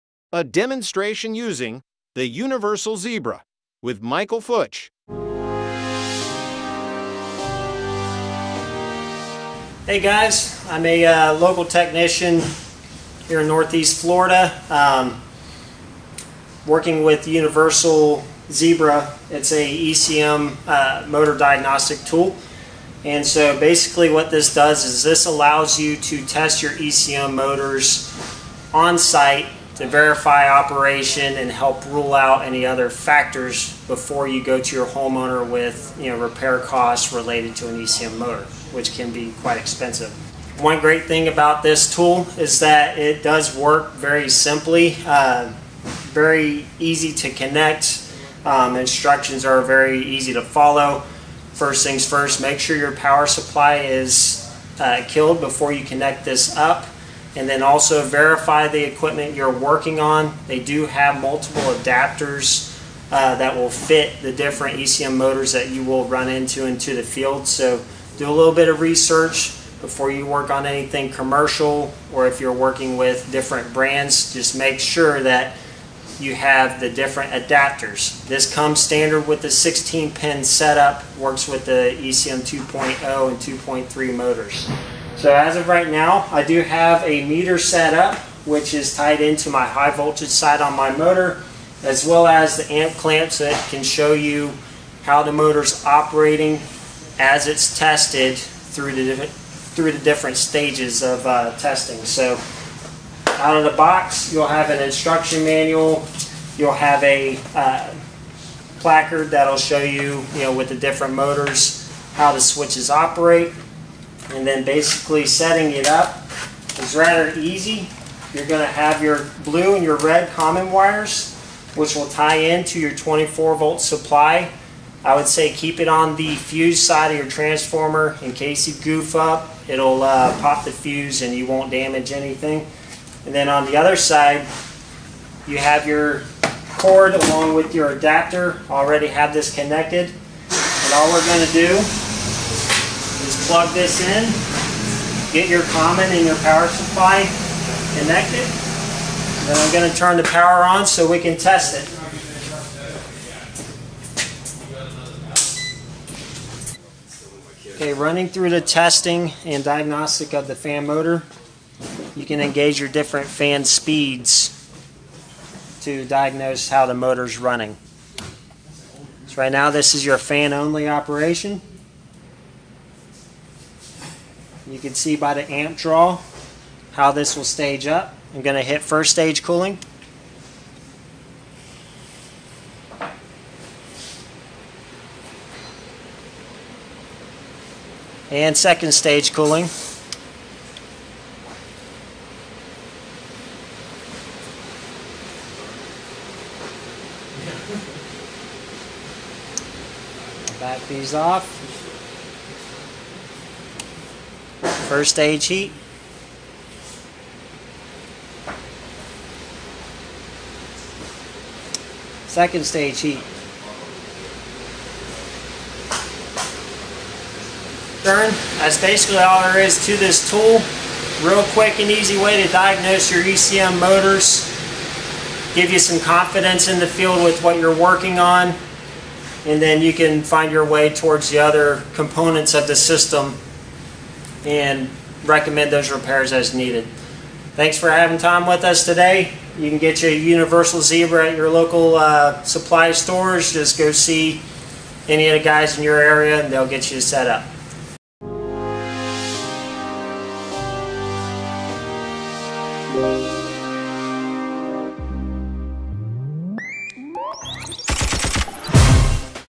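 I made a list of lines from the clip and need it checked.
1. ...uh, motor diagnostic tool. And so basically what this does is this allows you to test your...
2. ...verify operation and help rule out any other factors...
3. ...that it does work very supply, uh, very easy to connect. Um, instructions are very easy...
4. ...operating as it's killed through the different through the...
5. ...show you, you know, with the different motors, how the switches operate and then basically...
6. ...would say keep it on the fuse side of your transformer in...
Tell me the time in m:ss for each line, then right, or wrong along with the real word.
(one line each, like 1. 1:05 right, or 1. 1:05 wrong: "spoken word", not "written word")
1. 0:20 right
2. 0:29 right
3. 0:42 wrong: "simply", not "supply"
4. 1:35 wrong: "tested", not "killed"
5. 1:49 right
6. 2:05 right.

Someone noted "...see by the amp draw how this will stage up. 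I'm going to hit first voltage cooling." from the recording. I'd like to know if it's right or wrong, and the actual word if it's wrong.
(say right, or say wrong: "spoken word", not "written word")
wrong: "stage", not "voltage".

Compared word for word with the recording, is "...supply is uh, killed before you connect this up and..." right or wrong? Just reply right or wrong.
right.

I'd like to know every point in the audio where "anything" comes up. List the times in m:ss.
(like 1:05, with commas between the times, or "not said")
1:10, 2:12.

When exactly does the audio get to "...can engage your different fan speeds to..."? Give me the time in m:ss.
2:42.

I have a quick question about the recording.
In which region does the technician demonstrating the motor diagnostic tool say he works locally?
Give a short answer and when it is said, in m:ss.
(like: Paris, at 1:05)
Northeast Florida, at 0:13.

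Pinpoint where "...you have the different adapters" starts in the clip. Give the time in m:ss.
1:16.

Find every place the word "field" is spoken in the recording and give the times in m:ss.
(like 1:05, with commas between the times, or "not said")
1:07, 3:46.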